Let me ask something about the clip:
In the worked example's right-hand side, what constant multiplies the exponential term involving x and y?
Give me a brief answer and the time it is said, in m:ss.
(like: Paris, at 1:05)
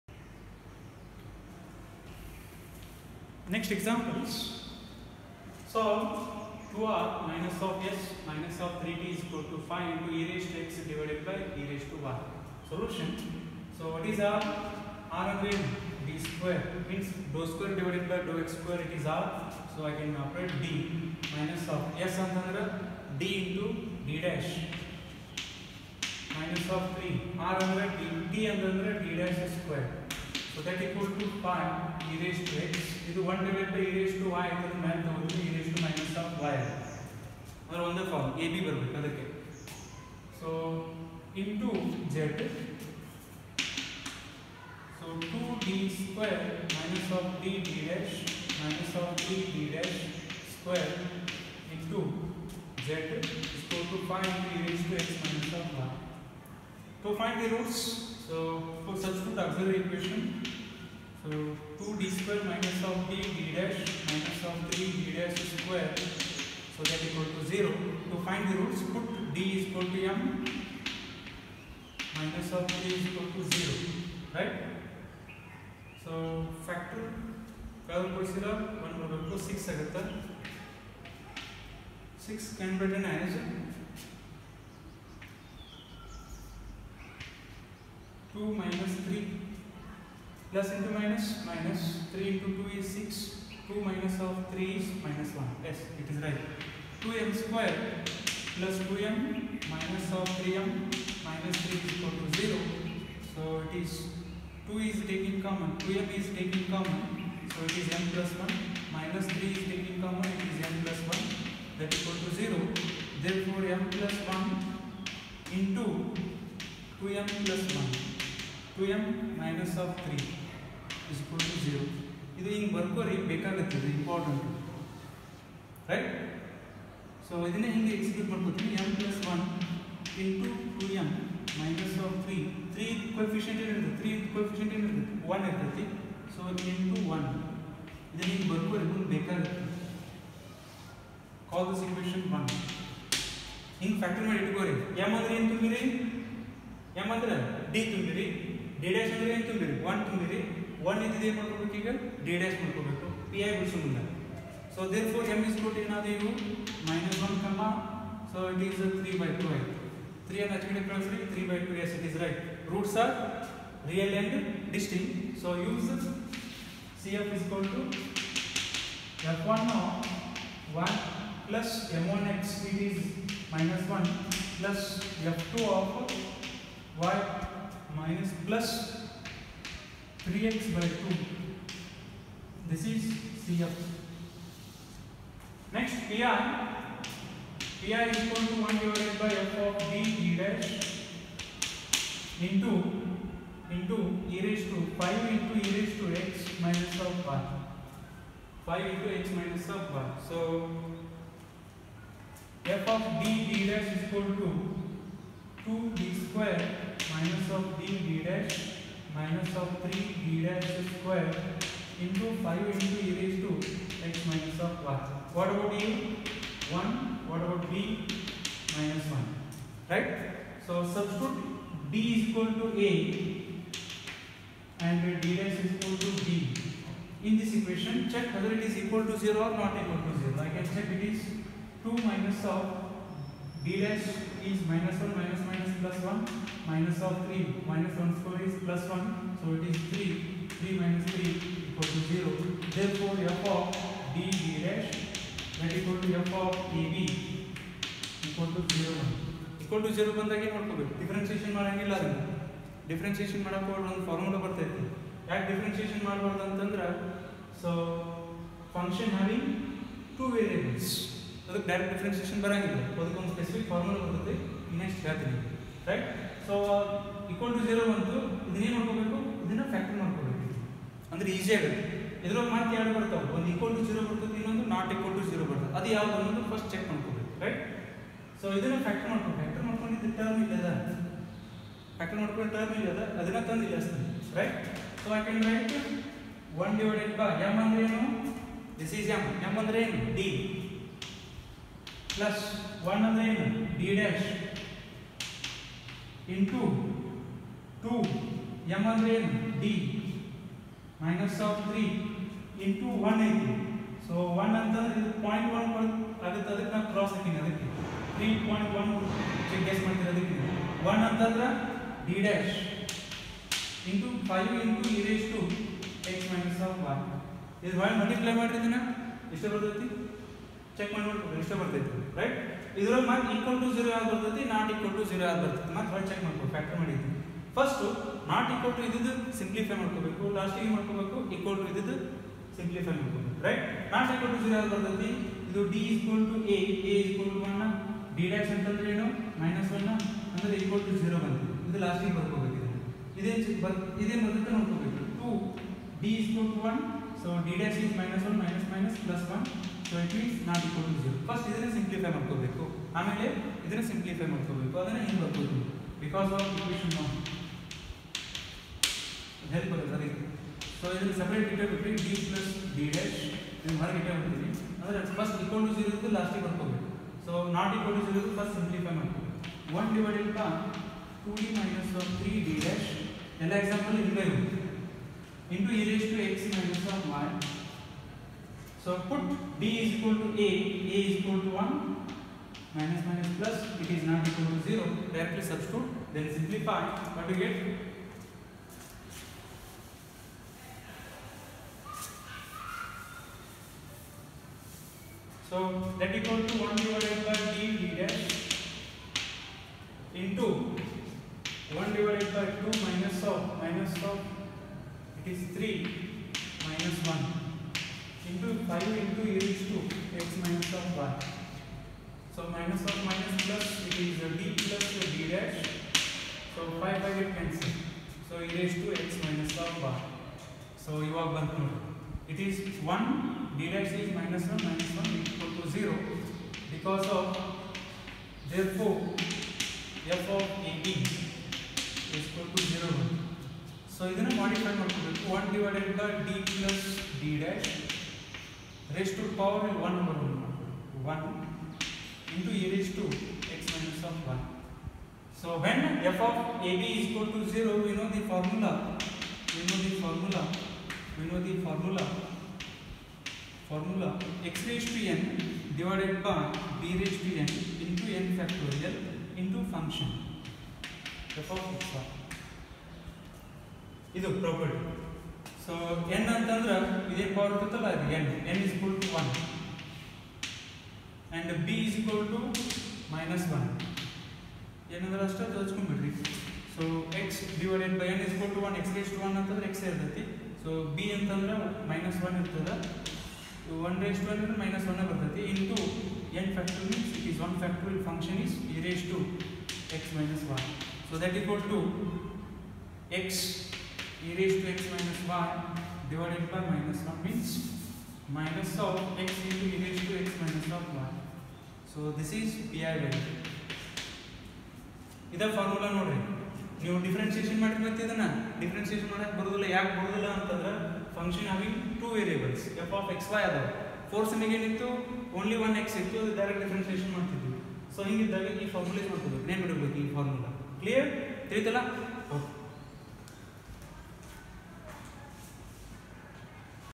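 5, at 0:09.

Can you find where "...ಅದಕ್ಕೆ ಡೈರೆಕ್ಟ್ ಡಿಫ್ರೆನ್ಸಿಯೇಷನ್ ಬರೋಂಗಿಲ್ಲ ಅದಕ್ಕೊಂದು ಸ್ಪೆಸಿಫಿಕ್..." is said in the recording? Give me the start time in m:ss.
4:21.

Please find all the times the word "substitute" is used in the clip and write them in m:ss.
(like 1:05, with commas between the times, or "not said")
0:58, 3:40, 6:25.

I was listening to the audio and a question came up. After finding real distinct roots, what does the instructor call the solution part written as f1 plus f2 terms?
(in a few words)
CF.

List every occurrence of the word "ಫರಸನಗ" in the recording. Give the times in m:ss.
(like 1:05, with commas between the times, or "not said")
8:34.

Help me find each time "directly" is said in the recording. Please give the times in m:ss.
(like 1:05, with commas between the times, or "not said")
6:25.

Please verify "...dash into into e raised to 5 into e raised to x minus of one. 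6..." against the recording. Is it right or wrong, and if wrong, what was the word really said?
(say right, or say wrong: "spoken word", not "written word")
wrong: "5", not "6".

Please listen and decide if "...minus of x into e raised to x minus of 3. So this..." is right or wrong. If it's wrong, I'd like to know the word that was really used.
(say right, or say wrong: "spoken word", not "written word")
wrong: "1", not "3".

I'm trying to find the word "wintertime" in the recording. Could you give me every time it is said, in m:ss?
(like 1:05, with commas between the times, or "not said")
not said.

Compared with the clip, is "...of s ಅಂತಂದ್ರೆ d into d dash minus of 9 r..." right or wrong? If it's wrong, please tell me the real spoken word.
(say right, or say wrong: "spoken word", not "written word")
wrong: "3", not "9".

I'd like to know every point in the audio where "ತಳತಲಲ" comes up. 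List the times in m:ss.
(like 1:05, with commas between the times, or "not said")
8:41.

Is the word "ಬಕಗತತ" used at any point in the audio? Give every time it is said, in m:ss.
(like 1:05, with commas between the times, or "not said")
2:03, 2:19.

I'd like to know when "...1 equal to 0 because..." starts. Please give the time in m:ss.
7:05.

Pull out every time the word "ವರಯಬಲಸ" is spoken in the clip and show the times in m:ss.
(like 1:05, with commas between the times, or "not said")
4:20, 8:32.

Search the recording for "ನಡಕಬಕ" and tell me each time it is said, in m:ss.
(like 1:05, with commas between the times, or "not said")
5:44.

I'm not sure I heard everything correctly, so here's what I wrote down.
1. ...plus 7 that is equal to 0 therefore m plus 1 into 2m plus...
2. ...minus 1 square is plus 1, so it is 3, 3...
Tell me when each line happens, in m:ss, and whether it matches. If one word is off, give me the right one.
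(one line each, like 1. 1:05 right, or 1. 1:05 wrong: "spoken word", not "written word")
1. 1:50 wrong: "1", not "7"
2. 3:57 right.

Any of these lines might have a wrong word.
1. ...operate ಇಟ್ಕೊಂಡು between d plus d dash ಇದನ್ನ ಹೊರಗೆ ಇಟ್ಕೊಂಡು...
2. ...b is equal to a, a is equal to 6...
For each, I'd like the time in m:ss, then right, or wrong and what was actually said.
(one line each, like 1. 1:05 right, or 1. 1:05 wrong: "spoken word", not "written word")
1. 6:01 wrong: "separate", not "operate"
2. 6:19 wrong: "1", not "6".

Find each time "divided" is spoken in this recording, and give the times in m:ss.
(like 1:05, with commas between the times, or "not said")
0:10, 0:17, 0:33, 3:08, 6:09, 6:36, 6:41, 8:16.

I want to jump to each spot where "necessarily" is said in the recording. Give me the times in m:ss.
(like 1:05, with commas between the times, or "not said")
not said.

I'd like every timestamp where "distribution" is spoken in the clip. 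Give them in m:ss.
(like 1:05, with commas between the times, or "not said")
not said.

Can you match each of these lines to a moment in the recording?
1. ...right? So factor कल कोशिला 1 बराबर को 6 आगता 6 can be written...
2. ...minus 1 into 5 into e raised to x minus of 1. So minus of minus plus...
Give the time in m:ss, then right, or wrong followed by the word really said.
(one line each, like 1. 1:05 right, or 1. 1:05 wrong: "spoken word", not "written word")
1. 1:14 right
2. 6:46 right.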